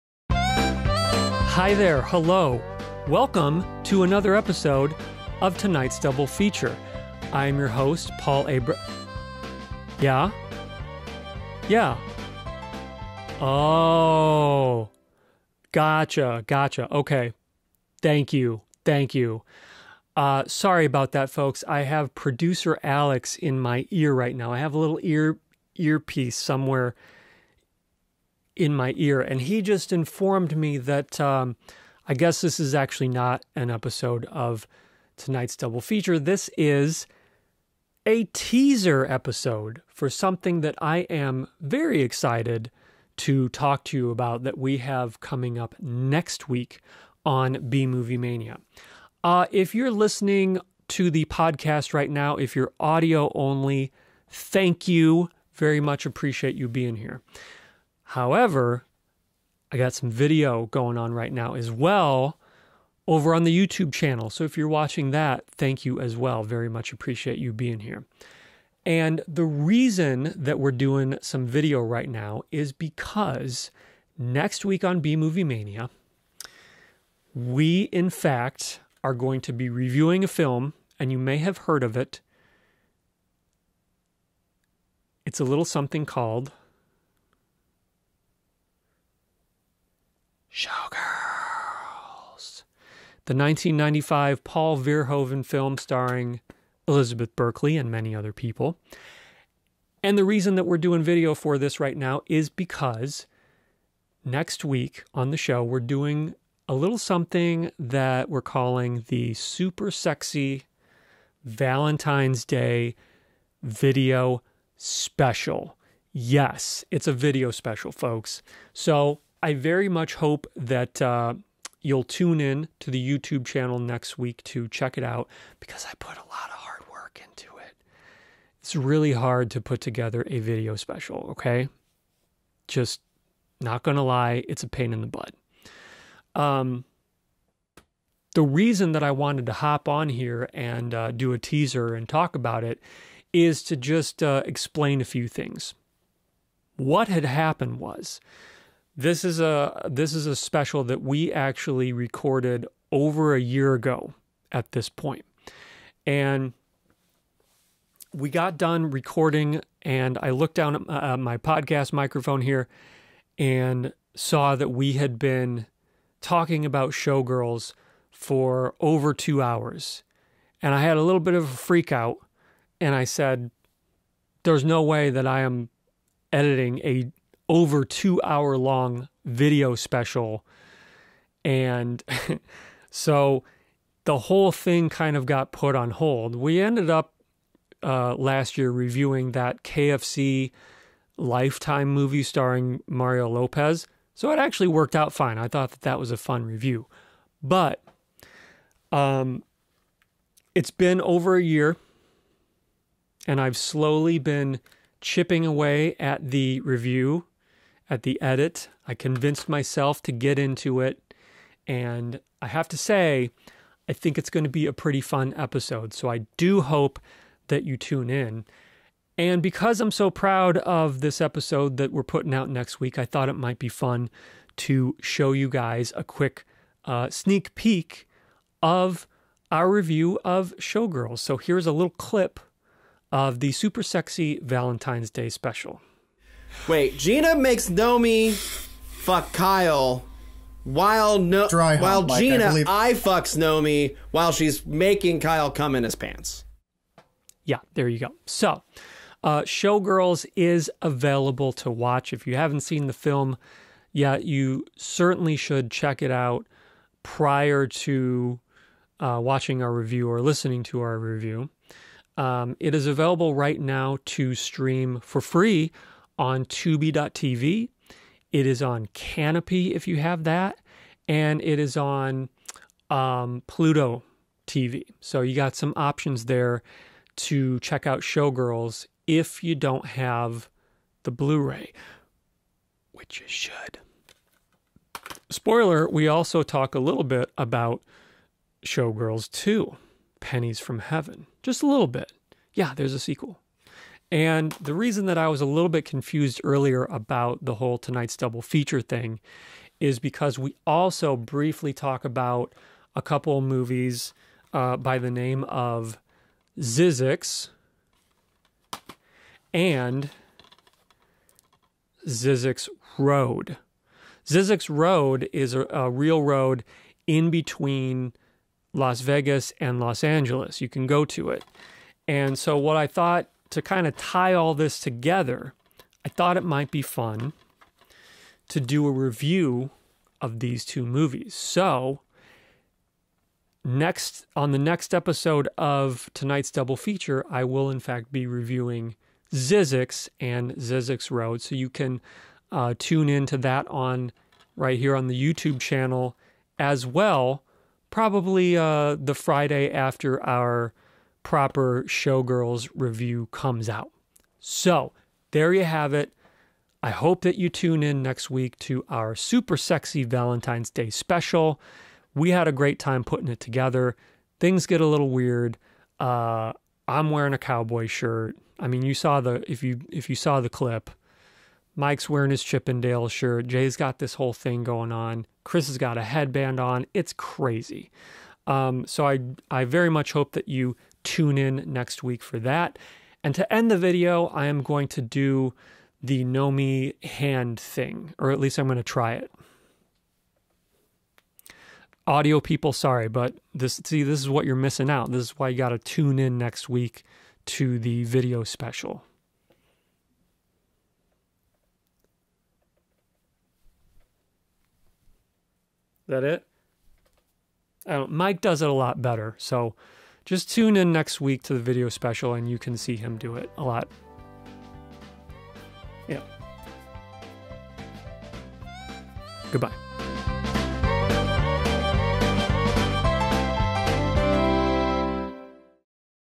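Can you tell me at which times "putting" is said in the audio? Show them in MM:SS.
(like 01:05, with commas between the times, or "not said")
03:42, 06:03.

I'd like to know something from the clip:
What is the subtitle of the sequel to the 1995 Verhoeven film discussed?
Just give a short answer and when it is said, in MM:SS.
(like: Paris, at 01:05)
Pennies from Heaven, at 04:50.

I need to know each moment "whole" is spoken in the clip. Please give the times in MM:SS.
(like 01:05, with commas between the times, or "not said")
03:04, 04:57, 06:14.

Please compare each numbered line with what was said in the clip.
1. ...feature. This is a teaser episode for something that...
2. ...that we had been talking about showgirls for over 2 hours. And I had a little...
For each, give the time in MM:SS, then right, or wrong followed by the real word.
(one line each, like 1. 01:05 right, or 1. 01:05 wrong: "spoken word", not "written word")
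1. 00:35 right
2. 02:44 right.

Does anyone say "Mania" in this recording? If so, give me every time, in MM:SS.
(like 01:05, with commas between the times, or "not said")
00:48, 01:15.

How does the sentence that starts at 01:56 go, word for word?
Yes, it's a video special, folks.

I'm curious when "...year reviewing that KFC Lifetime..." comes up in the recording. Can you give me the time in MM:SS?
03:08.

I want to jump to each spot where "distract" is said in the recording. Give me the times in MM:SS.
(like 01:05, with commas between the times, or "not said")
not said.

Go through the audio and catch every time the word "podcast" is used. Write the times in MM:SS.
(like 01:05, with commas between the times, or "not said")
00:51, 02:41.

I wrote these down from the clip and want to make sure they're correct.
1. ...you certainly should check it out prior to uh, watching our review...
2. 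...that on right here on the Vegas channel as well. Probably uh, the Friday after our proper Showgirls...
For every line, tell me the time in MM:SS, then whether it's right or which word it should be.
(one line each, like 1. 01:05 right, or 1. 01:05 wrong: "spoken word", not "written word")
1. 04:14 right
2. 05:43 wrong: "YouTube", not "Vegas".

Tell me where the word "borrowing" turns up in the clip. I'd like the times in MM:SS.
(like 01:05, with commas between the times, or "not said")
not said.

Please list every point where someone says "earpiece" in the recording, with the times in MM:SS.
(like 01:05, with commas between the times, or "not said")
00:25.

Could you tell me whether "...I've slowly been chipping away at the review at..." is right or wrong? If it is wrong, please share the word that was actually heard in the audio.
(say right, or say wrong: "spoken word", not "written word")
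right.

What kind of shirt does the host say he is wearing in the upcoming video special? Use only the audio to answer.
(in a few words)
cowboy shirt.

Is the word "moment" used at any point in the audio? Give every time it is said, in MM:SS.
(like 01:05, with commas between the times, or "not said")
not said.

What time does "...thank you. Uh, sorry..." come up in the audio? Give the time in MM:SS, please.
00:18.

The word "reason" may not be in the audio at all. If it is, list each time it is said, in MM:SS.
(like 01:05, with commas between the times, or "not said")
01:09, 01:40, 02:18, 04:54.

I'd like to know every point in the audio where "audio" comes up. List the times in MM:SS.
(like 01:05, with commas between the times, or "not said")
00:52, 06:32.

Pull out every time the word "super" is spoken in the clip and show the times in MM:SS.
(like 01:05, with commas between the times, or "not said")
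01:49, 03:53, 05:59.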